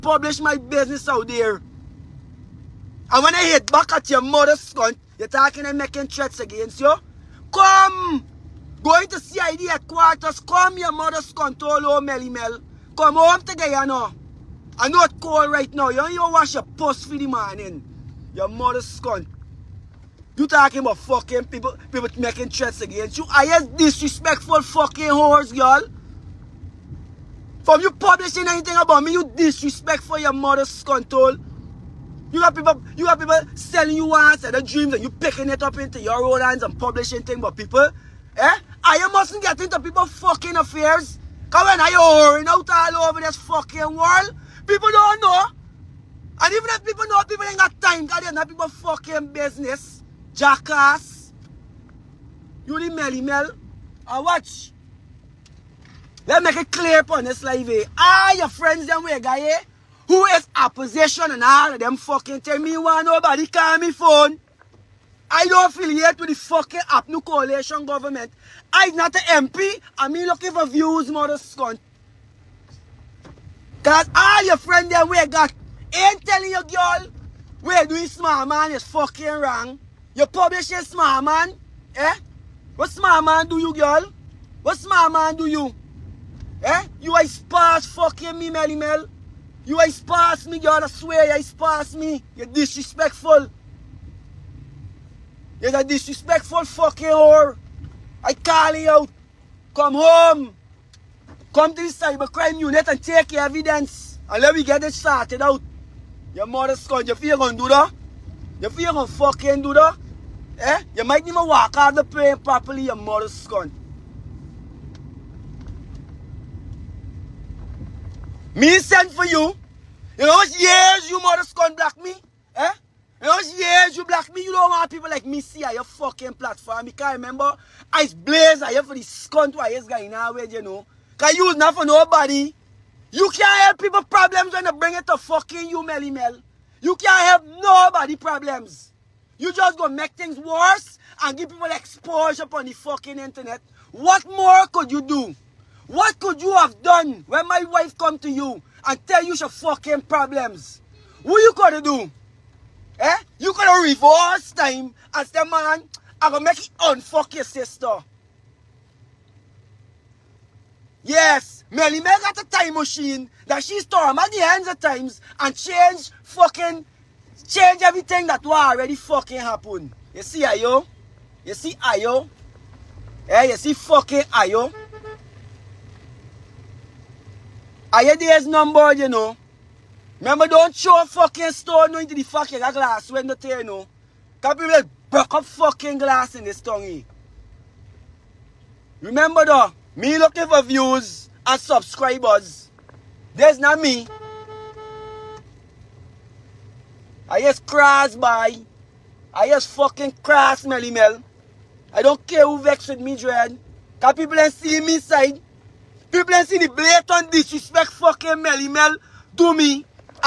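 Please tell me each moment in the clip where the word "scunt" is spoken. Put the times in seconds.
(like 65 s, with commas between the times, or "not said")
71 s, 129 s.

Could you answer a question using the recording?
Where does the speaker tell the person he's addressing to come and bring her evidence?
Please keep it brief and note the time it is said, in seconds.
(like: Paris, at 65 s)
cybercrime unit, at 101 s.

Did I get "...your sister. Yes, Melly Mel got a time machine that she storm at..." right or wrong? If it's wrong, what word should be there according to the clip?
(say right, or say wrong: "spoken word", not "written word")
right.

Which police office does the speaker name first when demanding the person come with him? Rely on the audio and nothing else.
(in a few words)
CID headquarters.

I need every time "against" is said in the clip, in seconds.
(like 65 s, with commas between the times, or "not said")
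6 s, 22 s.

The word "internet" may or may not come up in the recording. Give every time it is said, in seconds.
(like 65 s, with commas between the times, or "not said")
143 s.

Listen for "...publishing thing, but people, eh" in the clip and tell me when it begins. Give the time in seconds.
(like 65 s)
36 s.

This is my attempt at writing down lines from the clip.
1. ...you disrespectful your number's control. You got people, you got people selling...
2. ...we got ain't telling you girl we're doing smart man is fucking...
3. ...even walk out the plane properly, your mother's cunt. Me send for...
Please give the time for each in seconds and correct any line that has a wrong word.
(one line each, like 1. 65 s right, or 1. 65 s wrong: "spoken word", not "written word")
1. 29 s wrong: "mother", not "number"
2. 75 s right
3. 111 s right.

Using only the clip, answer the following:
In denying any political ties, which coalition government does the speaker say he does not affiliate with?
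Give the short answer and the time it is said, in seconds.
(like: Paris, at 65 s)
APNU, at 66 s.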